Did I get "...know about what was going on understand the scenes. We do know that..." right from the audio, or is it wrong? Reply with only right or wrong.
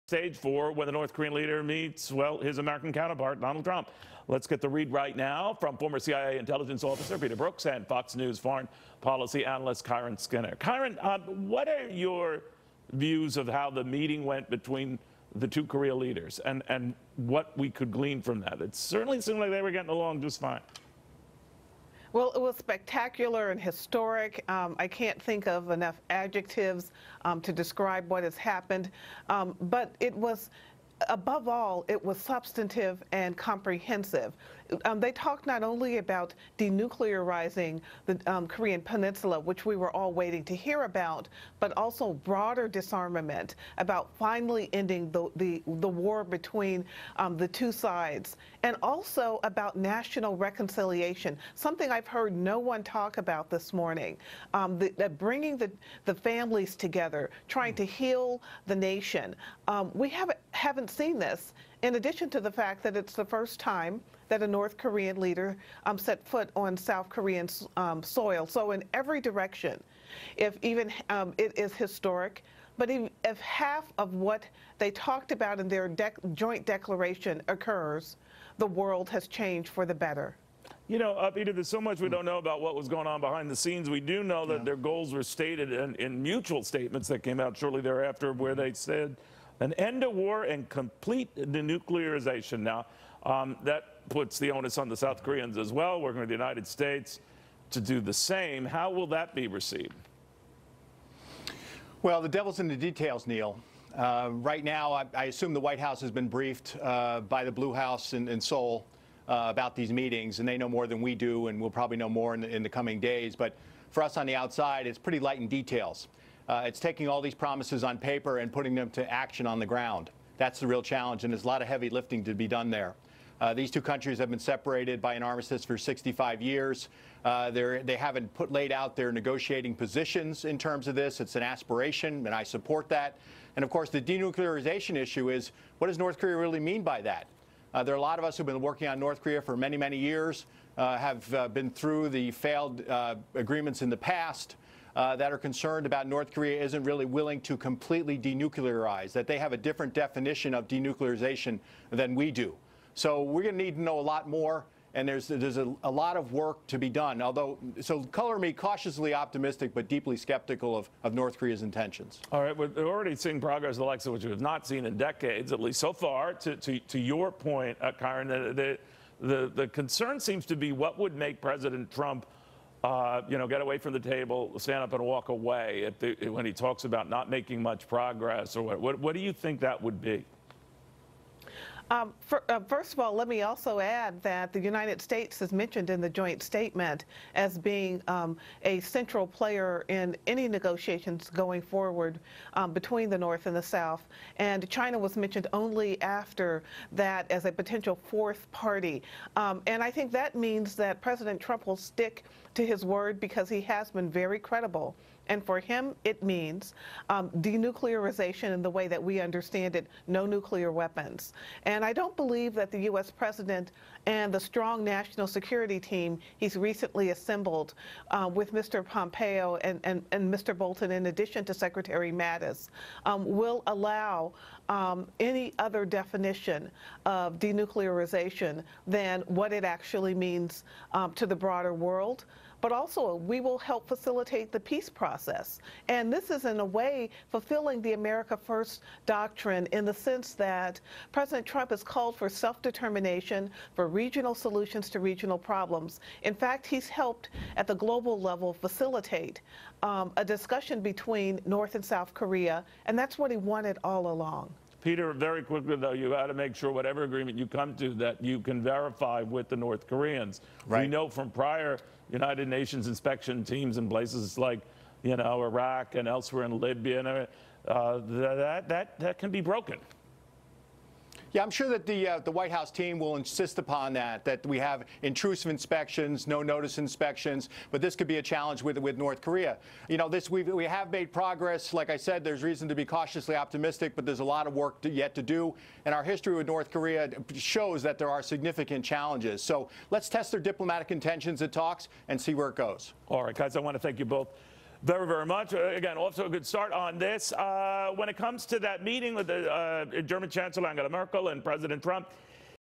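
wrong.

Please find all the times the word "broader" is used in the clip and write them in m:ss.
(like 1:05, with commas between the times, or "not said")
0:42, 3:51.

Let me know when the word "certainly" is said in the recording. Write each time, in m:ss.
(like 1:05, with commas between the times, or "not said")
0:18.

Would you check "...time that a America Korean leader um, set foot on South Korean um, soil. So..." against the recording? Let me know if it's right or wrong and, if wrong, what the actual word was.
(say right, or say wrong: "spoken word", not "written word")
wrong: "North", not "America".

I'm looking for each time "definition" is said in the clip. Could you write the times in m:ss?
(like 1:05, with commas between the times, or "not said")
2:29, 3:45.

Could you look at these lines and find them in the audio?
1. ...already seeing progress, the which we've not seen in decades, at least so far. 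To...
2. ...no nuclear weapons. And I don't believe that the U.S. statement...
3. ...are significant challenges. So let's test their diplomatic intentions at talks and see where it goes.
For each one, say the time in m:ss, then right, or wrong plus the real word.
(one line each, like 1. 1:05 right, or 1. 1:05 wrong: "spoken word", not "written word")
1. 2:42 right
2. 3:30 wrong: "president", not "statement"
3. 4:48 right.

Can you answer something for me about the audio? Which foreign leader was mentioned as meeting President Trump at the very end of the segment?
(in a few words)
Angela Merkel.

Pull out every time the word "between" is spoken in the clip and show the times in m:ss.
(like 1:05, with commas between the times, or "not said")
0:14, 0:46, 3:12, 4:10.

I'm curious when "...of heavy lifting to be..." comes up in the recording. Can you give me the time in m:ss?
2:01.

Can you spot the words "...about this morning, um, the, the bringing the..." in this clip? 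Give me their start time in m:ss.
0:53.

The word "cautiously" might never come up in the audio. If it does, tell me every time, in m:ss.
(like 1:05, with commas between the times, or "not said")
2:38, 4:42.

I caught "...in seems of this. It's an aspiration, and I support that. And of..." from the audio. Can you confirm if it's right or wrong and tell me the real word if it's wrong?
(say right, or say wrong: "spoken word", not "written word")
wrong: "terms", not "seems".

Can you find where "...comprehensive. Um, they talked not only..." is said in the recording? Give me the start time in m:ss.
0:33.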